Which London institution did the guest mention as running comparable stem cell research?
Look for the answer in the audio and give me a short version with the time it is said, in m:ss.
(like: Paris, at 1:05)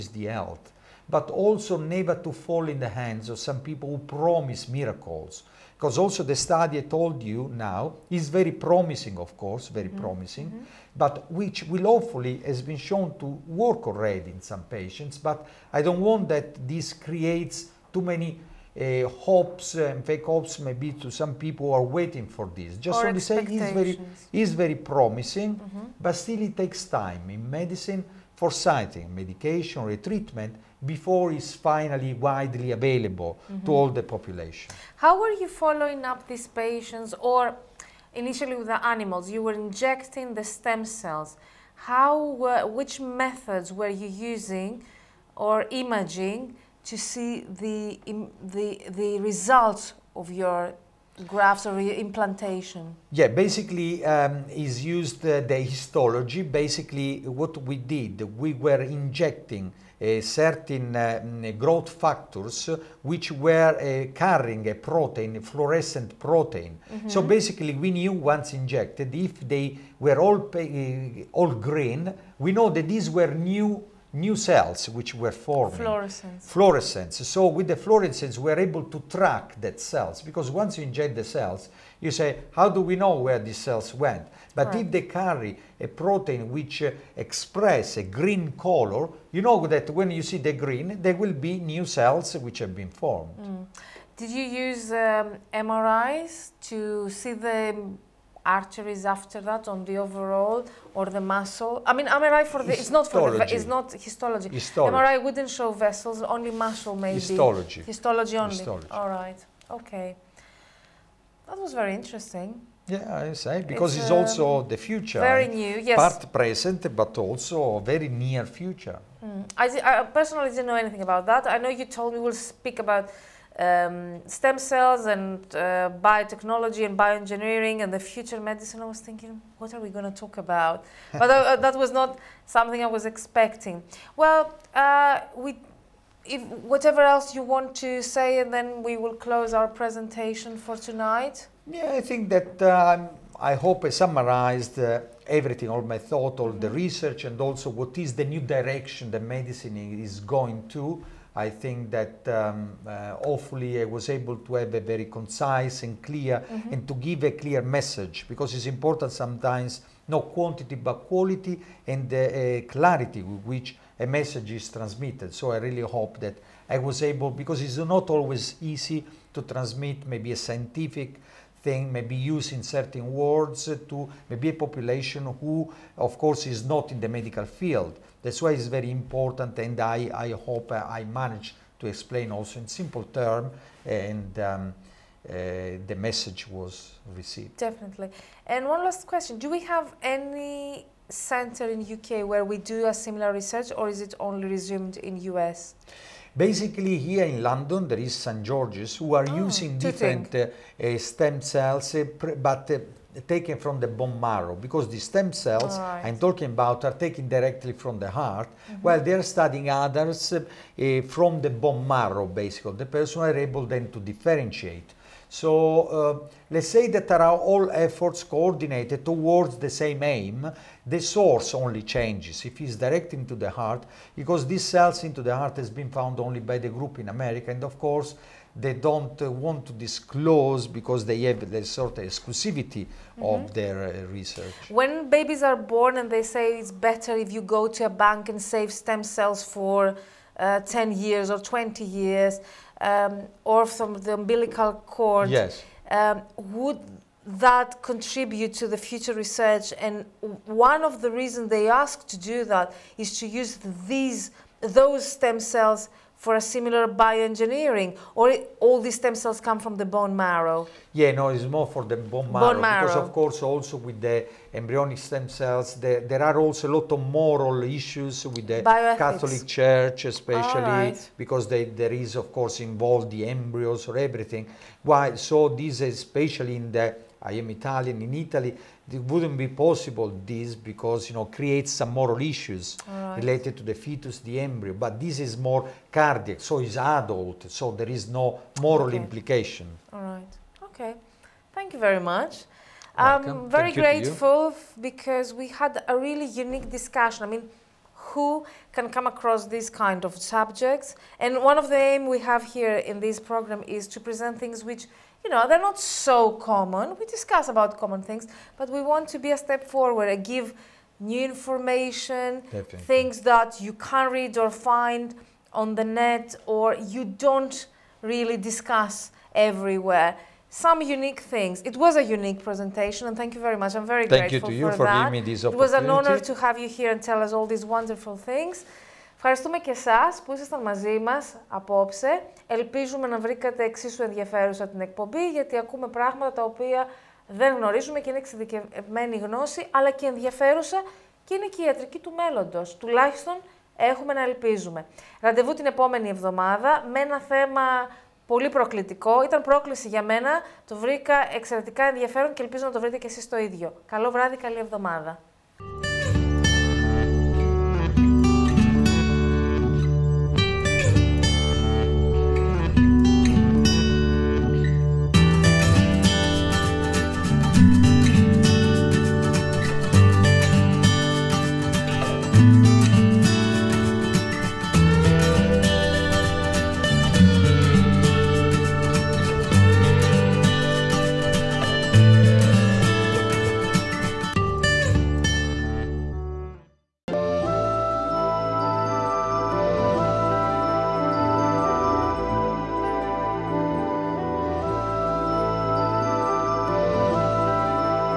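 St. George's, at 3:18.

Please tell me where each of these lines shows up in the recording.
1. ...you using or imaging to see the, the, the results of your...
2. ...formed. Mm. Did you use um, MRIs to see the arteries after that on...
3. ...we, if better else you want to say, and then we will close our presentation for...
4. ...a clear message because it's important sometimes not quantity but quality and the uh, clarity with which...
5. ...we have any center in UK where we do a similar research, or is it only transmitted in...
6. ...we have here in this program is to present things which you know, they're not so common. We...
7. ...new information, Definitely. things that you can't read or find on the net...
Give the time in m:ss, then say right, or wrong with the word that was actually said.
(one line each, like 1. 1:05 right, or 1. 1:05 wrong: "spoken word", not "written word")
1. 0:43 right
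2. 1:32 right
3. 2:15 wrong: "whatever", not "better"
4. 2:37 right
5. 3:09 wrong: "resumed", not "transmitted"
6. 5:02 right
7. 5:10 right.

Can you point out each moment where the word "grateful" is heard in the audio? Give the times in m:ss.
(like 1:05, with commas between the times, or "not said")
4:53, 5:24.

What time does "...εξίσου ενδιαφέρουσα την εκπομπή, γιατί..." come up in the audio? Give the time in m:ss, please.
5:33.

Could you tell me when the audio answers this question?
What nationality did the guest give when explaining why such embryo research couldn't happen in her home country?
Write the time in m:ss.
4:37.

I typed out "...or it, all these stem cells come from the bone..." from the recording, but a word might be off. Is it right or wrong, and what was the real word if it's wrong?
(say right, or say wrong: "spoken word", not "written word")
right.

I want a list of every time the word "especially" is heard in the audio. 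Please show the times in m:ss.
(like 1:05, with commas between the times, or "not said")
4:30, 4:35.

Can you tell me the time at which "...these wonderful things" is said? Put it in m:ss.
5:27.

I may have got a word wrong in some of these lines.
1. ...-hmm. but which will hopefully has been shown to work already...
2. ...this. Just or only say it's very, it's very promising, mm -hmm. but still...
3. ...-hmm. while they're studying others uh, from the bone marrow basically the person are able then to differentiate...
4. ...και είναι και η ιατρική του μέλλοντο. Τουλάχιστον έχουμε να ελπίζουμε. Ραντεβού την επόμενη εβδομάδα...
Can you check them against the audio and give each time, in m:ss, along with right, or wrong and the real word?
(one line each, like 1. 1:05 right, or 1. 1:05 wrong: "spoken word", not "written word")
1. 0:10 right
2. 0:22 right
3. 3:28 right
4. 5:41 right.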